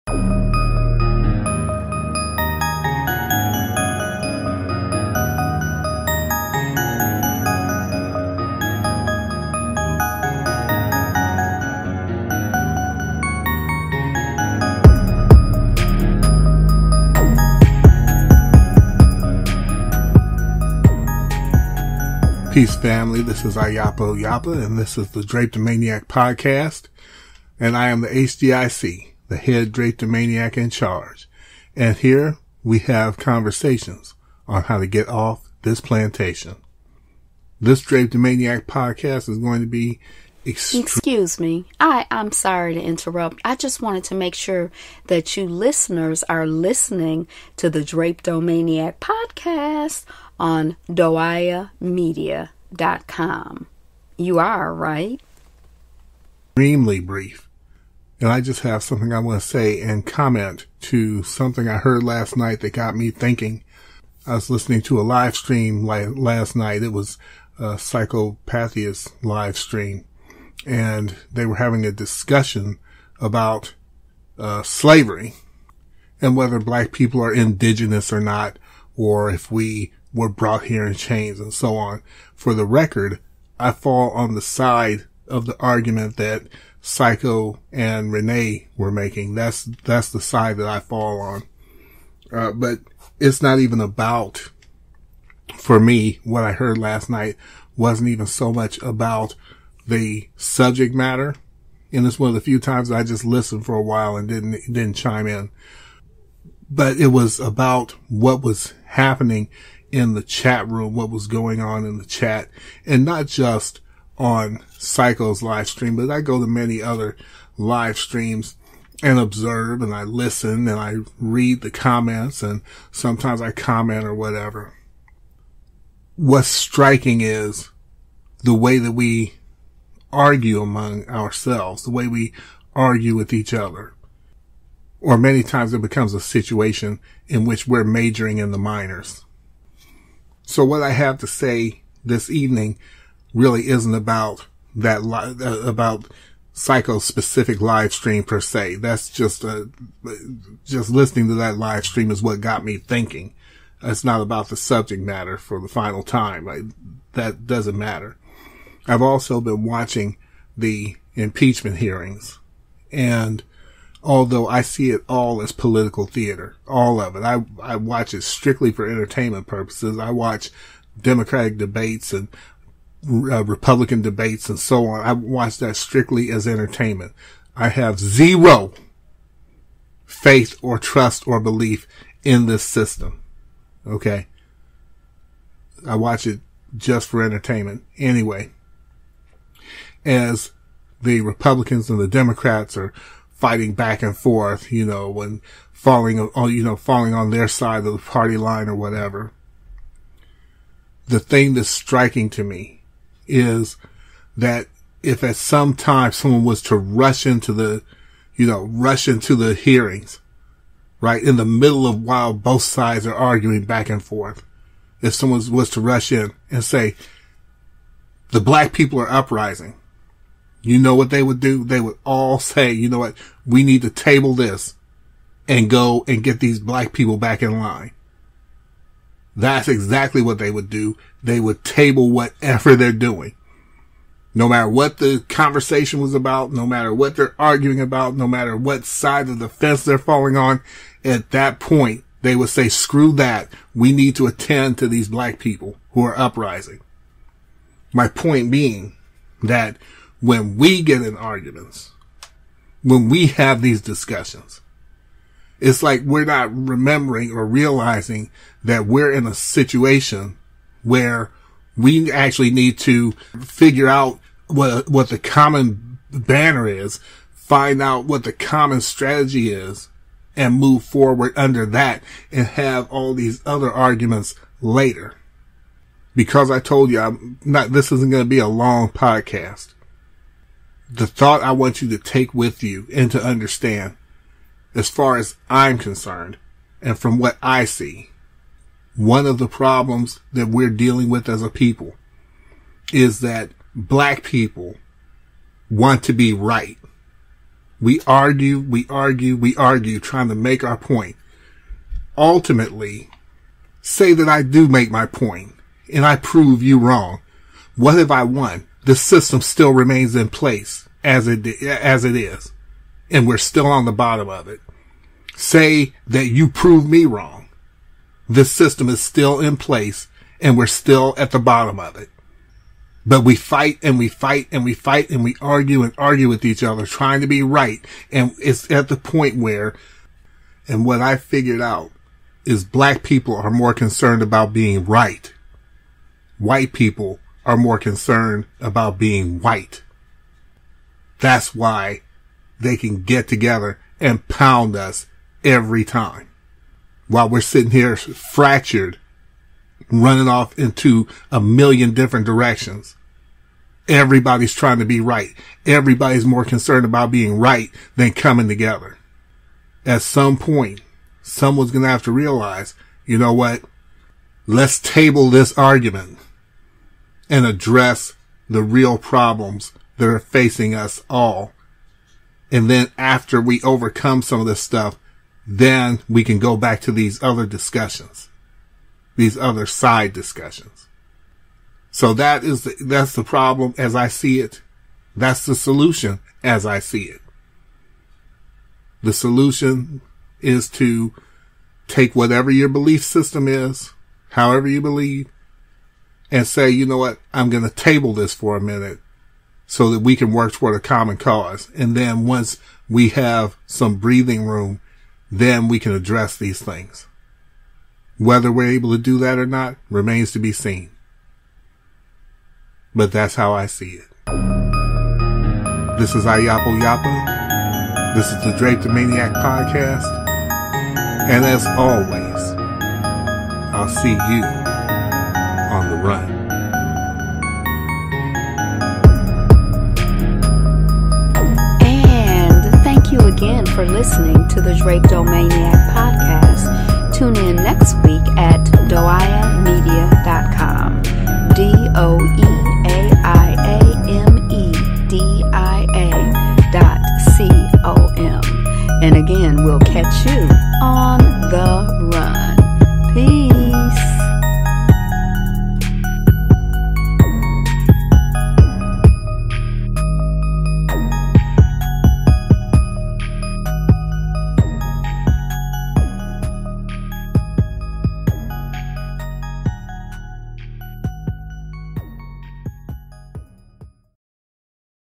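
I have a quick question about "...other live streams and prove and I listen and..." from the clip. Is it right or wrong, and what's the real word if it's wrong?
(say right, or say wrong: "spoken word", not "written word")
wrong: "observe", not "prove".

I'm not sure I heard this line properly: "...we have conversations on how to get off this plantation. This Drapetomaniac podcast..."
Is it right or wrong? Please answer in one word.
right.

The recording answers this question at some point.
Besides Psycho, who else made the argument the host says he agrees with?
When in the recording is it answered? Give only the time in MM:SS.
01:28.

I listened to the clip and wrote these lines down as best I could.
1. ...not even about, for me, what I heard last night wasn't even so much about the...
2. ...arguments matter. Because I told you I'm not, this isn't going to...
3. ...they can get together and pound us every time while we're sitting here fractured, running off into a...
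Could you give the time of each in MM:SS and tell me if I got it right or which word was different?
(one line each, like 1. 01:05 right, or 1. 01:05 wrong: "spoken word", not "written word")
1. 01:33 right
2. 04:33 wrong: "later", not "matter"
3. 05:42 right.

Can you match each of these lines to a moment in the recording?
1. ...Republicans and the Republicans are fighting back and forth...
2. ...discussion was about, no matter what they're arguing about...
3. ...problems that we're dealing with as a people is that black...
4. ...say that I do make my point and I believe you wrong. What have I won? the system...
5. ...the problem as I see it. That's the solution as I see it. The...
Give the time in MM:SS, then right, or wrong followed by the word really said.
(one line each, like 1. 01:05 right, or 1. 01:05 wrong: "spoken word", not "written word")
1. 03:11 wrong: "Democrats", not "Republicans"
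2. 03:55 wrong: "conversation", not "discussion"
3. 04:49 right
4. 05:03 wrong: "prove", not "believe"
5. 06:23 right.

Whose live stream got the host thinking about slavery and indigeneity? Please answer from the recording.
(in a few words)
Psychopathia.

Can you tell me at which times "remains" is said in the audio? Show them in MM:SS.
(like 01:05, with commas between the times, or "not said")
05:09, 06:49.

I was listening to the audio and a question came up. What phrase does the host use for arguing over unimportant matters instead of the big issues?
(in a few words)
majoring in the minors.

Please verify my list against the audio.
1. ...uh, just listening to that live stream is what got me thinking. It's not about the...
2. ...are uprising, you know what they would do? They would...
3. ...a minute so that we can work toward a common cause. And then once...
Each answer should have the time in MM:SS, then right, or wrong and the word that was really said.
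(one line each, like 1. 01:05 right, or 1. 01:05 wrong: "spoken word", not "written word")
1. 02:30 right
2. 03:38 right
3. 06:38 right.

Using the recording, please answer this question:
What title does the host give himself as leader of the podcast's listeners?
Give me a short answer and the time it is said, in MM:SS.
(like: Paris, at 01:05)
HDIC, at 00:28.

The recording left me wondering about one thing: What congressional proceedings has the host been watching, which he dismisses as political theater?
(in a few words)
impeachment hearings.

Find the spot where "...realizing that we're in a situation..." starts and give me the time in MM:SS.
04:17.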